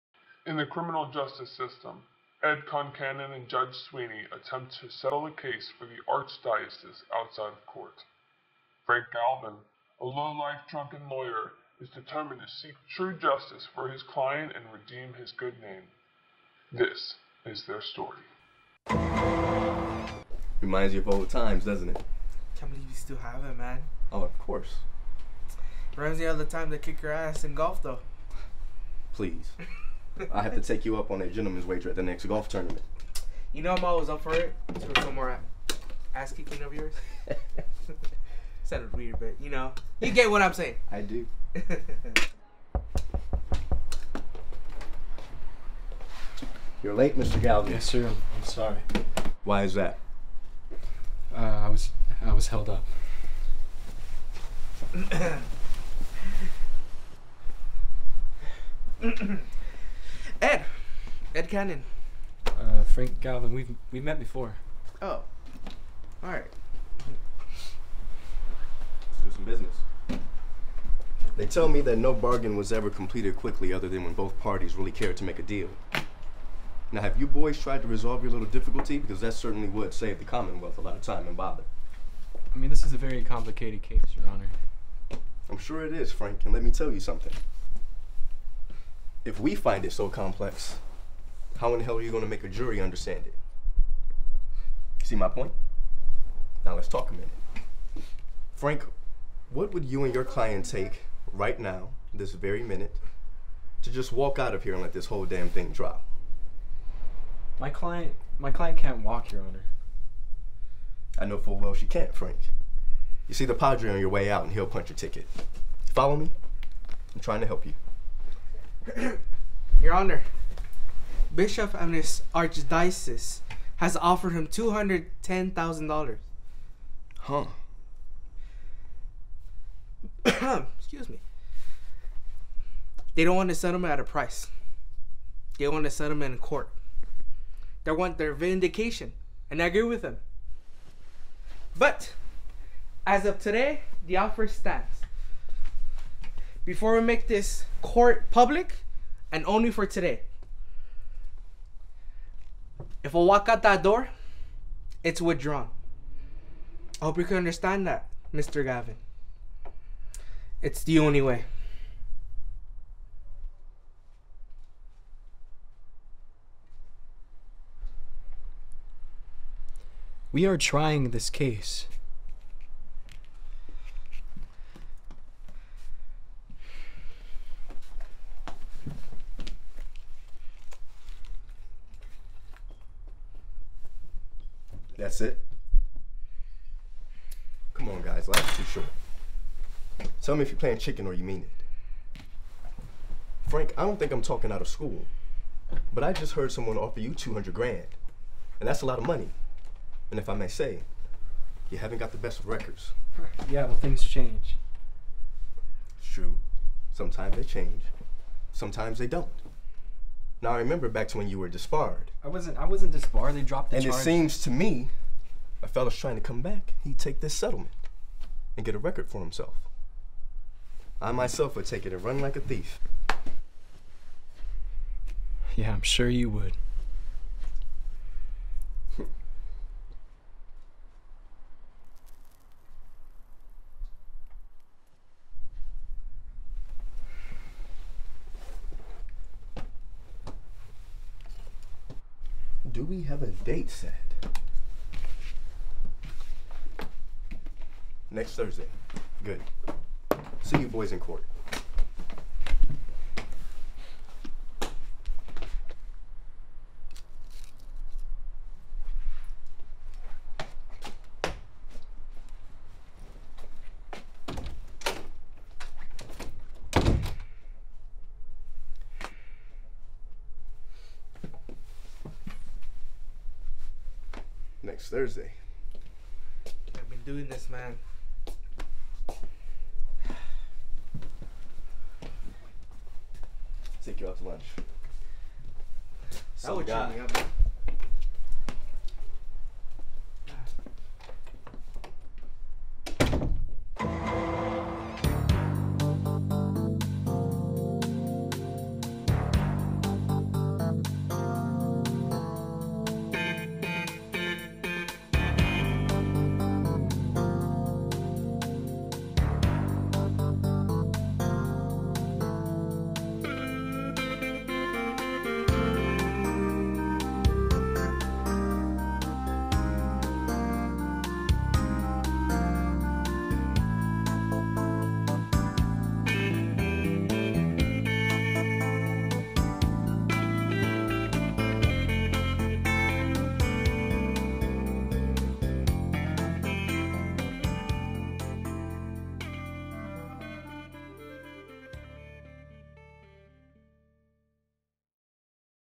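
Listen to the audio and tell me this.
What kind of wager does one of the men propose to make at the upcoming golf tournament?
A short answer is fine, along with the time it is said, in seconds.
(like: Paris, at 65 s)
gentleman's wager, at 31 s.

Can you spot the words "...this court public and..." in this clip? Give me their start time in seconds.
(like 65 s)
147 s.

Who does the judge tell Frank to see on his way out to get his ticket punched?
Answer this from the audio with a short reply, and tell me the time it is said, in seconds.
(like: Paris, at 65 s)
the Padre, at 113 s.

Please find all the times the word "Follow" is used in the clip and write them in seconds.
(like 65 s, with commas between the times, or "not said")
115 s.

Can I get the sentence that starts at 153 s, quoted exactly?
If I walk out that door, it's withdrawn.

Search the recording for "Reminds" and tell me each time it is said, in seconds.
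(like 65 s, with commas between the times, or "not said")
20 s, 25 s.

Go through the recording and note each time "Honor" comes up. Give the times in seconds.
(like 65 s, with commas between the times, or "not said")
84 s, 109 s, 119 s.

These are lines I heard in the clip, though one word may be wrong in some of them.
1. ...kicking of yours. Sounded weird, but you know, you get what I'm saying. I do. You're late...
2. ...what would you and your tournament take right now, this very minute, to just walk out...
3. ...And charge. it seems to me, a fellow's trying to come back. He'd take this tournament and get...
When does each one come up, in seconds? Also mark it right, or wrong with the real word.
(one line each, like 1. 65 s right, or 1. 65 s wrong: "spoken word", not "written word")
1. 36 s right
2. 99 s wrong: "client", not "tournament"
3. 213 s wrong: "settlement", not "tournament".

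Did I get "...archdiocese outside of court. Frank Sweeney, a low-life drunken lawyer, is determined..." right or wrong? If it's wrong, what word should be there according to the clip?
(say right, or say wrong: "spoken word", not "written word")
wrong: "Galvin", not "Sweeney".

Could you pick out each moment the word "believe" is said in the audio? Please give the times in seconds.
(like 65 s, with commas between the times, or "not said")
22 s.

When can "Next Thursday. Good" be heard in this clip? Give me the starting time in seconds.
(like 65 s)
248 s.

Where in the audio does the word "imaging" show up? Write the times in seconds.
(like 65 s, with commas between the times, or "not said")
not said.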